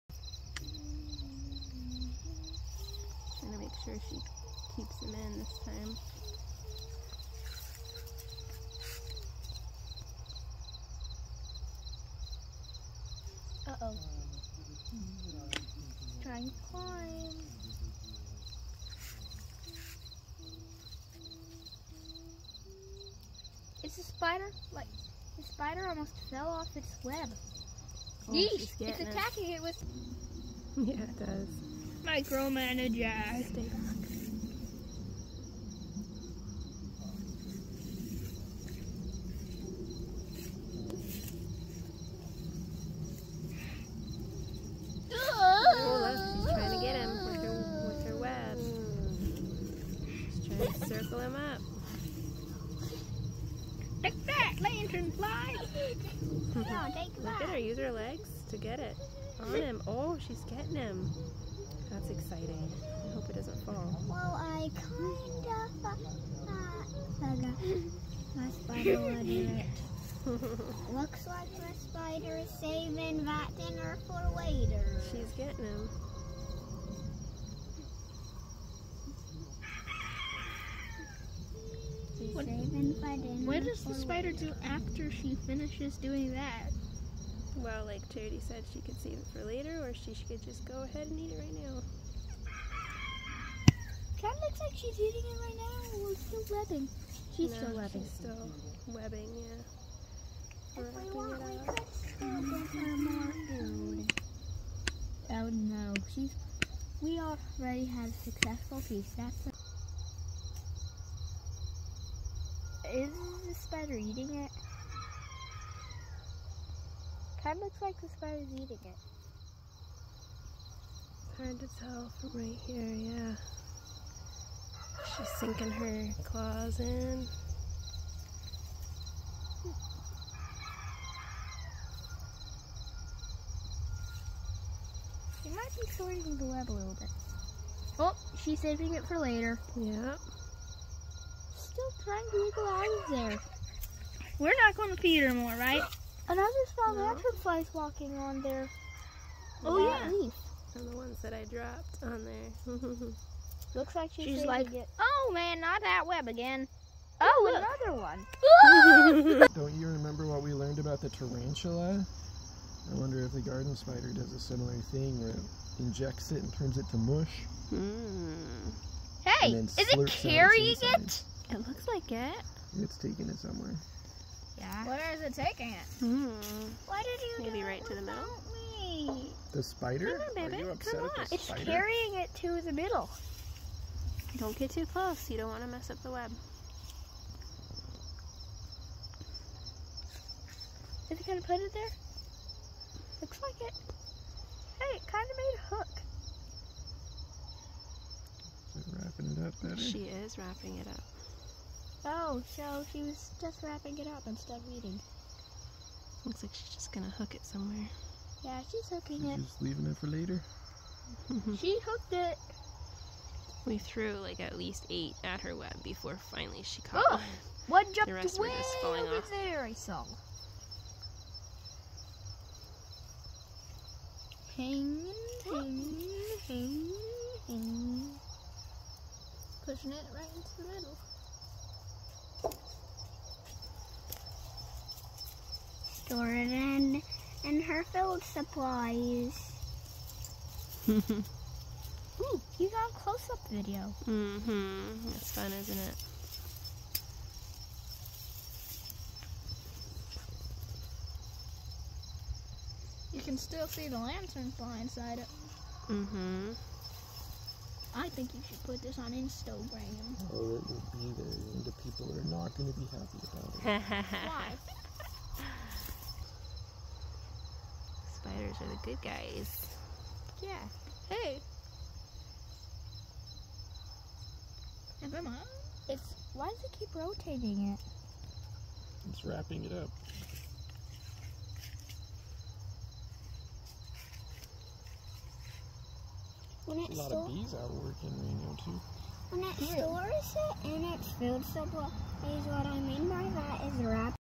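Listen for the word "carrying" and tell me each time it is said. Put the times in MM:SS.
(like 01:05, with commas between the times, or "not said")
02:50, 03:01.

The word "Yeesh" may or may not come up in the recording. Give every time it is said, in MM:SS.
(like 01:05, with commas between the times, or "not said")
00:28.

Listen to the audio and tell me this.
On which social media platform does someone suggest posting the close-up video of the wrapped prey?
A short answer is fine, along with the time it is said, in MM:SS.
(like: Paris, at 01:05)
Instagram, at 04:19.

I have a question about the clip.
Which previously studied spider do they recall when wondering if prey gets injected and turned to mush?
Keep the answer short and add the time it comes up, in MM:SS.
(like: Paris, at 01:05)
tarantula, at 02:41.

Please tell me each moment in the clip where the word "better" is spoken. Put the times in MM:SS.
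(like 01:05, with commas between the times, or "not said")
03:19.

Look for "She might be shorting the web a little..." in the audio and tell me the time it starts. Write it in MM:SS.
02:15.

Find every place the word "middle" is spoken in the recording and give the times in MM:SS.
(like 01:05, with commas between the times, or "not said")
02:58, 03:02, 03:50.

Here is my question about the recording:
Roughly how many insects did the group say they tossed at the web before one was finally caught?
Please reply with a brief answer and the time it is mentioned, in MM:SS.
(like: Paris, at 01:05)
8, at 03:34.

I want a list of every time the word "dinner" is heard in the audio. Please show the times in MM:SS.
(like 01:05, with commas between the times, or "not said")
01:13, 01:23.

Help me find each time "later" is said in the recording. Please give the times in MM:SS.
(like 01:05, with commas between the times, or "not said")
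01:14, 01:29, 02:19, 03:30.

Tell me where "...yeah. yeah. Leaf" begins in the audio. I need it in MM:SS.
02:29.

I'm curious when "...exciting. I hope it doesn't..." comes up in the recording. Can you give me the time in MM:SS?
01:02.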